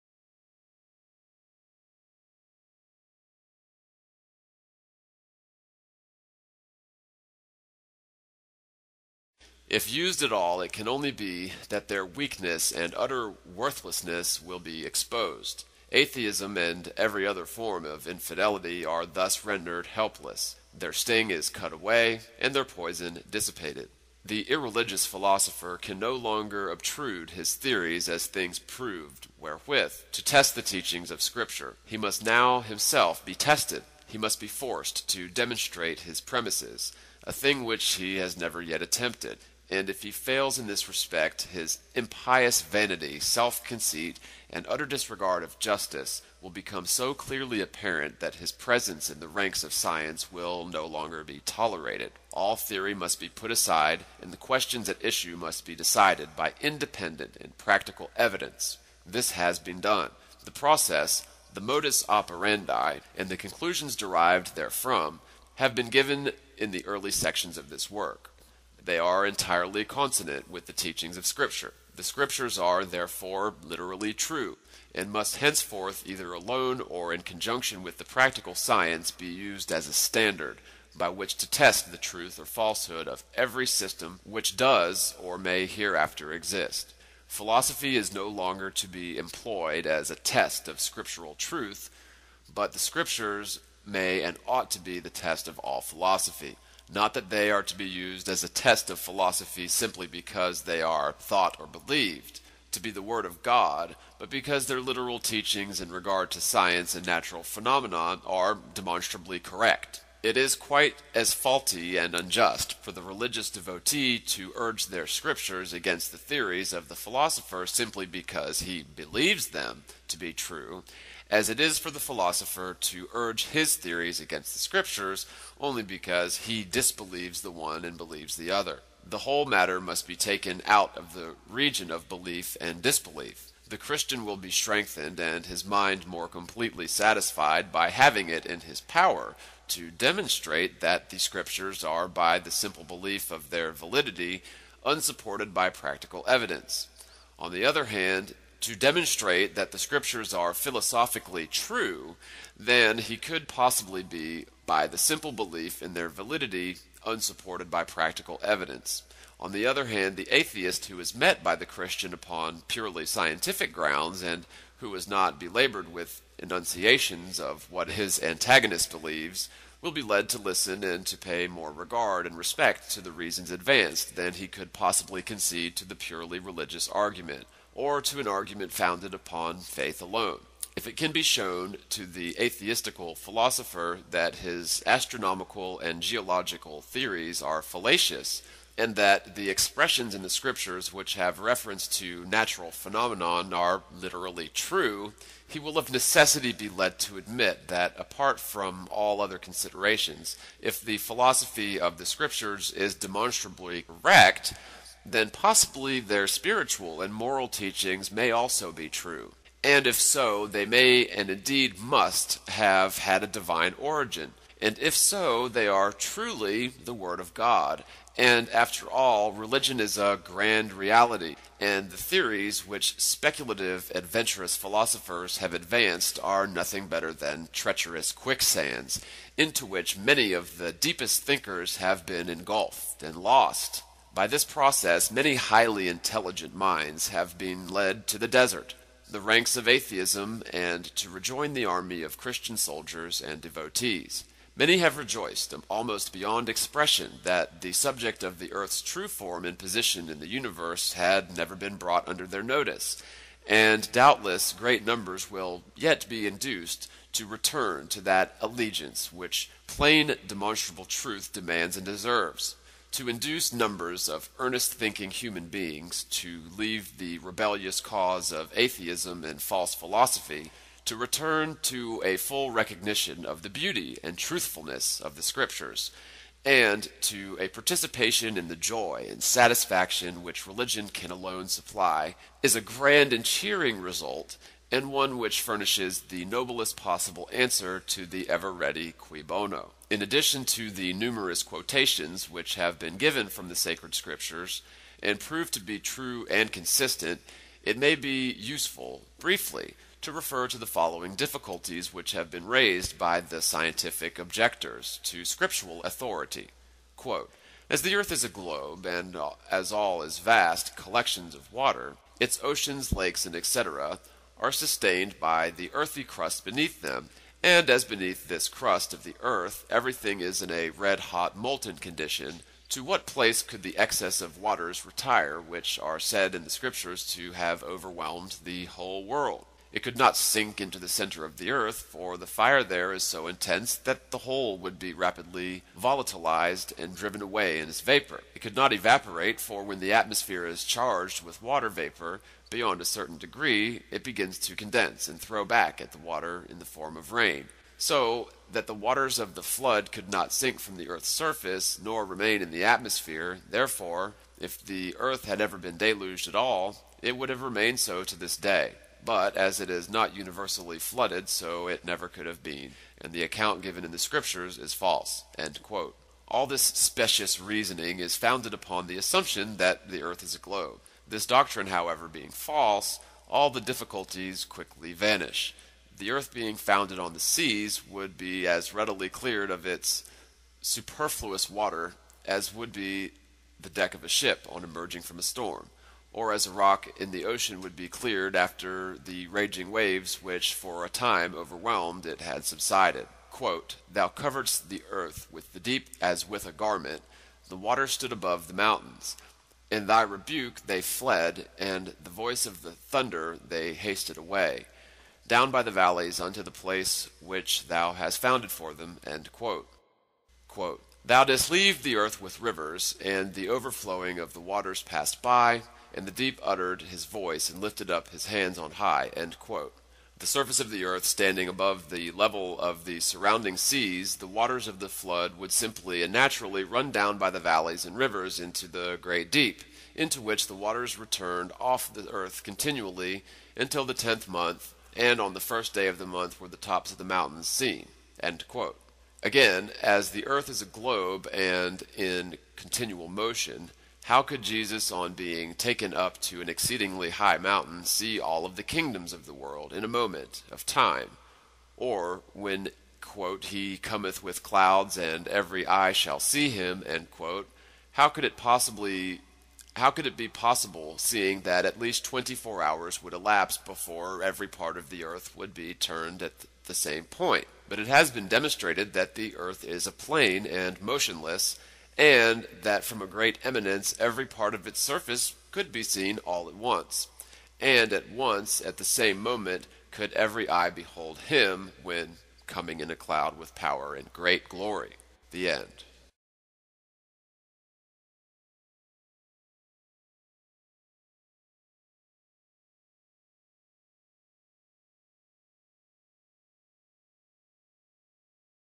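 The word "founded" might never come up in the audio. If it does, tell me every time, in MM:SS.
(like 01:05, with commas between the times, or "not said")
02:58, 06:08, 06:16, 06:48.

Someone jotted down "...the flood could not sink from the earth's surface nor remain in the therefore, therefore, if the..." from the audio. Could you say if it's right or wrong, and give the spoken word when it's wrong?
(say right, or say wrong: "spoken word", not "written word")
wrong: "atmosphere", not "therefore".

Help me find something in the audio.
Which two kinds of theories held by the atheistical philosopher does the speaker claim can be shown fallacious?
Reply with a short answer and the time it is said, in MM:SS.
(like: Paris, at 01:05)
Astronomical and geological, at 03:04.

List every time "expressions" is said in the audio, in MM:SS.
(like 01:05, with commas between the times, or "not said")
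03:09, 04:06.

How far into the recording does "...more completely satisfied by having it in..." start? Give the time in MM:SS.
02:16.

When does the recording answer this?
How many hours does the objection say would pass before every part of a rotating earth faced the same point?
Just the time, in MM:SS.
07:42.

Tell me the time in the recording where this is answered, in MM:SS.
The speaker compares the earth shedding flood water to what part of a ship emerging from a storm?
06:23.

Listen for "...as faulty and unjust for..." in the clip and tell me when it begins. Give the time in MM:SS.
01:51.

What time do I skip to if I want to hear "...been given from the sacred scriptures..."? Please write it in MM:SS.
04:52.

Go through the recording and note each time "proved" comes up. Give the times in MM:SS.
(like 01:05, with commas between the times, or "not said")
00:28, 04:55.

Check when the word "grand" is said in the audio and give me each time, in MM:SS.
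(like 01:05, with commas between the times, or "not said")
03:40, 04:42.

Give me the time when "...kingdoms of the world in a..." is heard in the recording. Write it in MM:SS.
07:28.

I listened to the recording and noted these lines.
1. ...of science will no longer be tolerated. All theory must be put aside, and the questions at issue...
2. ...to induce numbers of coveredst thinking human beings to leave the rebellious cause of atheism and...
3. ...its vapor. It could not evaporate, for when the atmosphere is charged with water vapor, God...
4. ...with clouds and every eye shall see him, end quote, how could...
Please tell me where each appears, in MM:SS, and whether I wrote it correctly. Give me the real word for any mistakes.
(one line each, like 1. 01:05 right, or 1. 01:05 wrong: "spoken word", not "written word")
1. 00:49 right
2. 04:22 wrong: "earnest", not "coveredst"
3. 05:37 wrong: "Beyond", not "God"
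4. 07:34 right.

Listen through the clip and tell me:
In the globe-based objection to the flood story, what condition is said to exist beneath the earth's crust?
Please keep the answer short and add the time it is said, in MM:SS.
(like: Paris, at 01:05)
Red hot molten, at 05:20.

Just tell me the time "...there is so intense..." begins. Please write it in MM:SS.
05:32.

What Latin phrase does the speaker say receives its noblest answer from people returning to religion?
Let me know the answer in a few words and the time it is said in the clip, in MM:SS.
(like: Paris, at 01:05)
Cui Bono, at 04:48.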